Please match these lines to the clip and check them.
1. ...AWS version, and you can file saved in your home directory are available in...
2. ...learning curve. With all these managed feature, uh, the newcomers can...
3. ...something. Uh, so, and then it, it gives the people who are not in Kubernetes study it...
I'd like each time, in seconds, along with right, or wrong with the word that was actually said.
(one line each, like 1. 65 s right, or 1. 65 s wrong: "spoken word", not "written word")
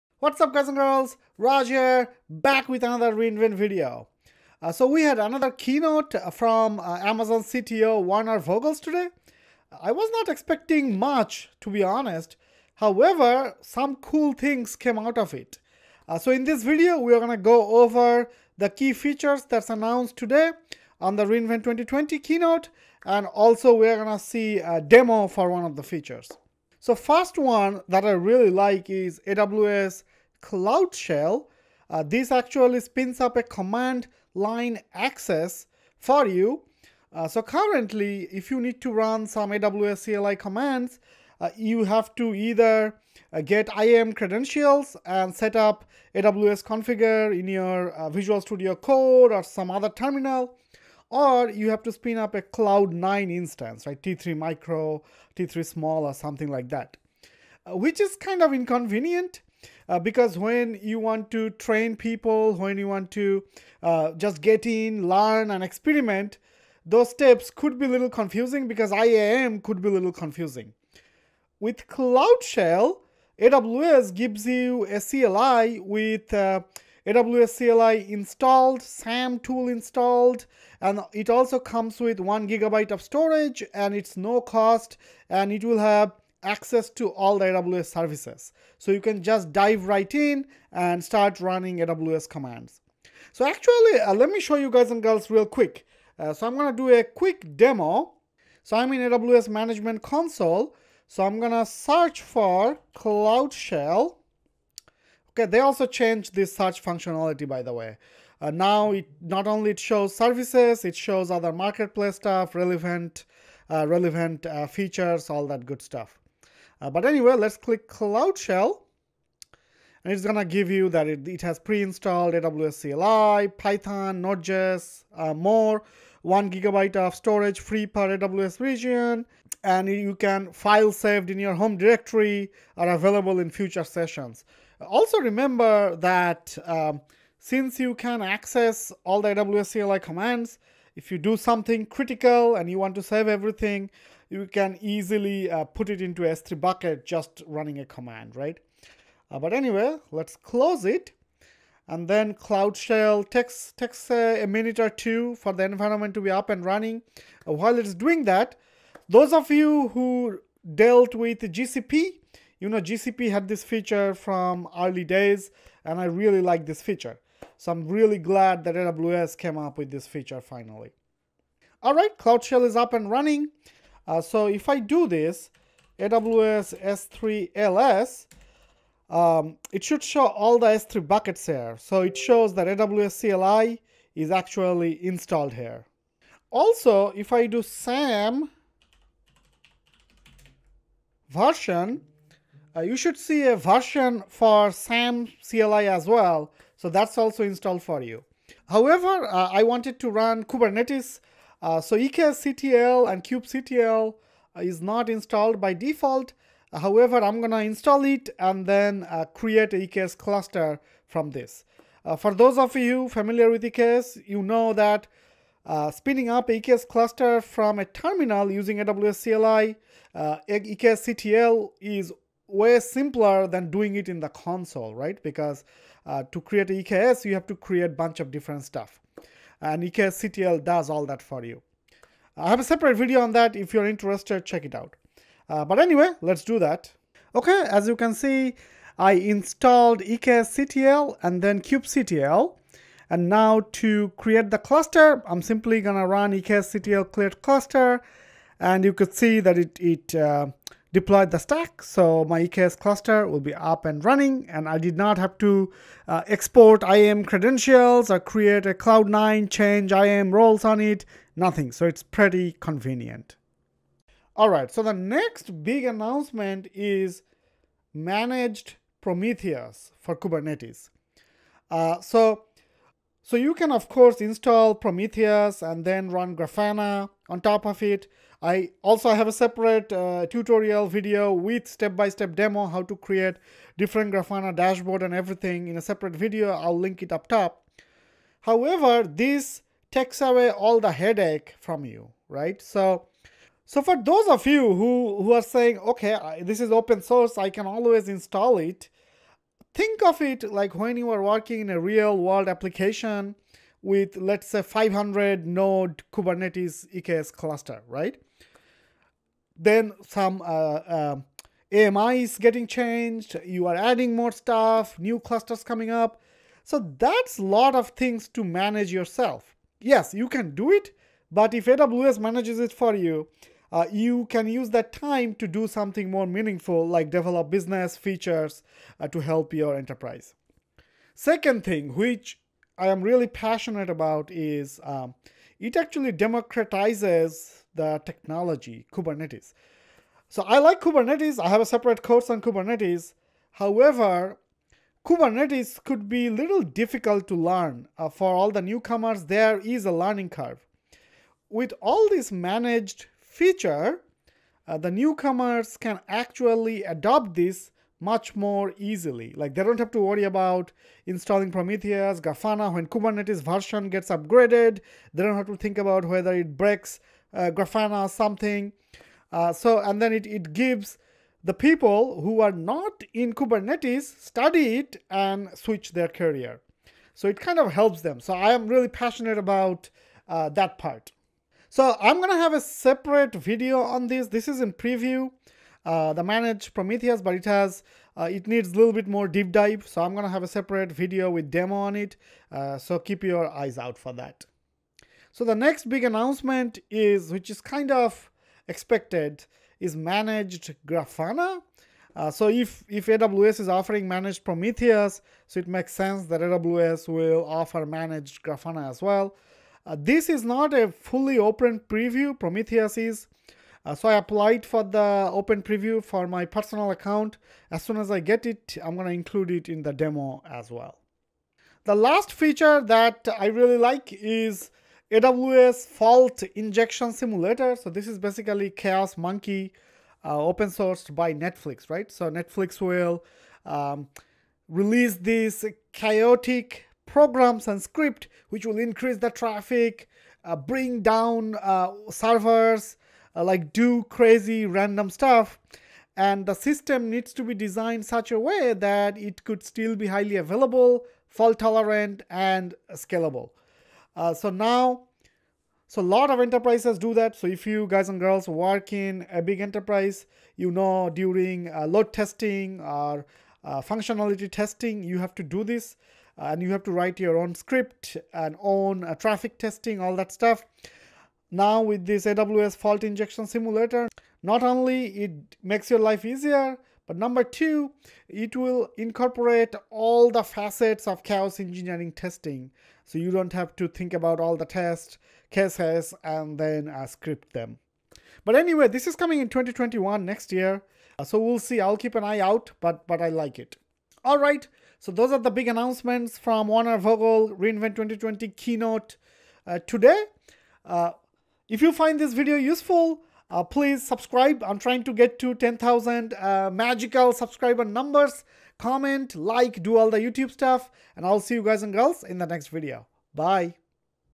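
1. 128 s wrong: "region", not "version"
2. 349 s right
3. 368 s right.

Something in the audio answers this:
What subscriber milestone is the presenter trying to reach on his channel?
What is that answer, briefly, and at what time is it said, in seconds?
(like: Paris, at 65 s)
10,000, at 505 s.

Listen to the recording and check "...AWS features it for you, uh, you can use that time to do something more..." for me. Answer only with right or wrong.
wrong.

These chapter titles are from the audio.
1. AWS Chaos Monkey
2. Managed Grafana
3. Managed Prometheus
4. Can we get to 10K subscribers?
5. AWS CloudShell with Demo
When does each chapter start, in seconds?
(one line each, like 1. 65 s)
1. 420 s
2. 395 s
3. 263 s
4. 500 s
5. 27 s.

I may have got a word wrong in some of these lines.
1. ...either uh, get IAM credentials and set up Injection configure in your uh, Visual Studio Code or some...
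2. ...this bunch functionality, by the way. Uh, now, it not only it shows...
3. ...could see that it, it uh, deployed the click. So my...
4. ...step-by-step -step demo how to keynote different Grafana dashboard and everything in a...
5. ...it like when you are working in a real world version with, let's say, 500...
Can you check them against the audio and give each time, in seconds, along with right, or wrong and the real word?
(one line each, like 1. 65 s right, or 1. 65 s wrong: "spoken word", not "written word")
1. 42 s wrong: "AWS", not "Injection"
2. 106 s wrong: "search", not "bunch"
3. 248 s wrong: "stack", not "click"
4. 281 s wrong: "create", not "keynote"
5. 300 s wrong: "application", not "version".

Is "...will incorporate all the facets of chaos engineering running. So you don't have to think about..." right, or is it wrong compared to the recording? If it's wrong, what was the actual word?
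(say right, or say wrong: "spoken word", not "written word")
wrong: "testing", not "running".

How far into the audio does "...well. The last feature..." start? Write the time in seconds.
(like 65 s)
420 s.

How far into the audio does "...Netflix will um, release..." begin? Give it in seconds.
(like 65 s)
432 s.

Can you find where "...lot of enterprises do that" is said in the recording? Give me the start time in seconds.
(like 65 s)
456 s.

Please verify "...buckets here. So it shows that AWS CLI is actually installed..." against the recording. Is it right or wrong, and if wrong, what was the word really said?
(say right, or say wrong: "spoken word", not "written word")
right.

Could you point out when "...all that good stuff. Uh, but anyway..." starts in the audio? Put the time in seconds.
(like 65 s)
115 s.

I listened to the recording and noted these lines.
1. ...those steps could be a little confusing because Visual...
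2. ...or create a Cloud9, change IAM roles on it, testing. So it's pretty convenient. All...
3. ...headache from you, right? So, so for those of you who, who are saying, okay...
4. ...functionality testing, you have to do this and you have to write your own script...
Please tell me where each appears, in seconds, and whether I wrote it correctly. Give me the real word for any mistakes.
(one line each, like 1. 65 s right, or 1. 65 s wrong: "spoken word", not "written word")
1. 66 s wrong: "IAM", not "Visual"
2. 258 s wrong: "nothing", not "testing"
3. 290 s right
4. 463 s right.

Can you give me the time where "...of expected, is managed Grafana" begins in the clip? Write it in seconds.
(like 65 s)
397 s.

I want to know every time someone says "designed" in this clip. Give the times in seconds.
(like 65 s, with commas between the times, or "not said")
447 s.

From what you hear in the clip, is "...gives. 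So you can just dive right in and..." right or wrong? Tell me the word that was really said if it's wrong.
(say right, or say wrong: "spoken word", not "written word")
wrong: "services", not "gives".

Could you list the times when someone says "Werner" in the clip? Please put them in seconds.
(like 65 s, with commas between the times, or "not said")
8 s, 496 s.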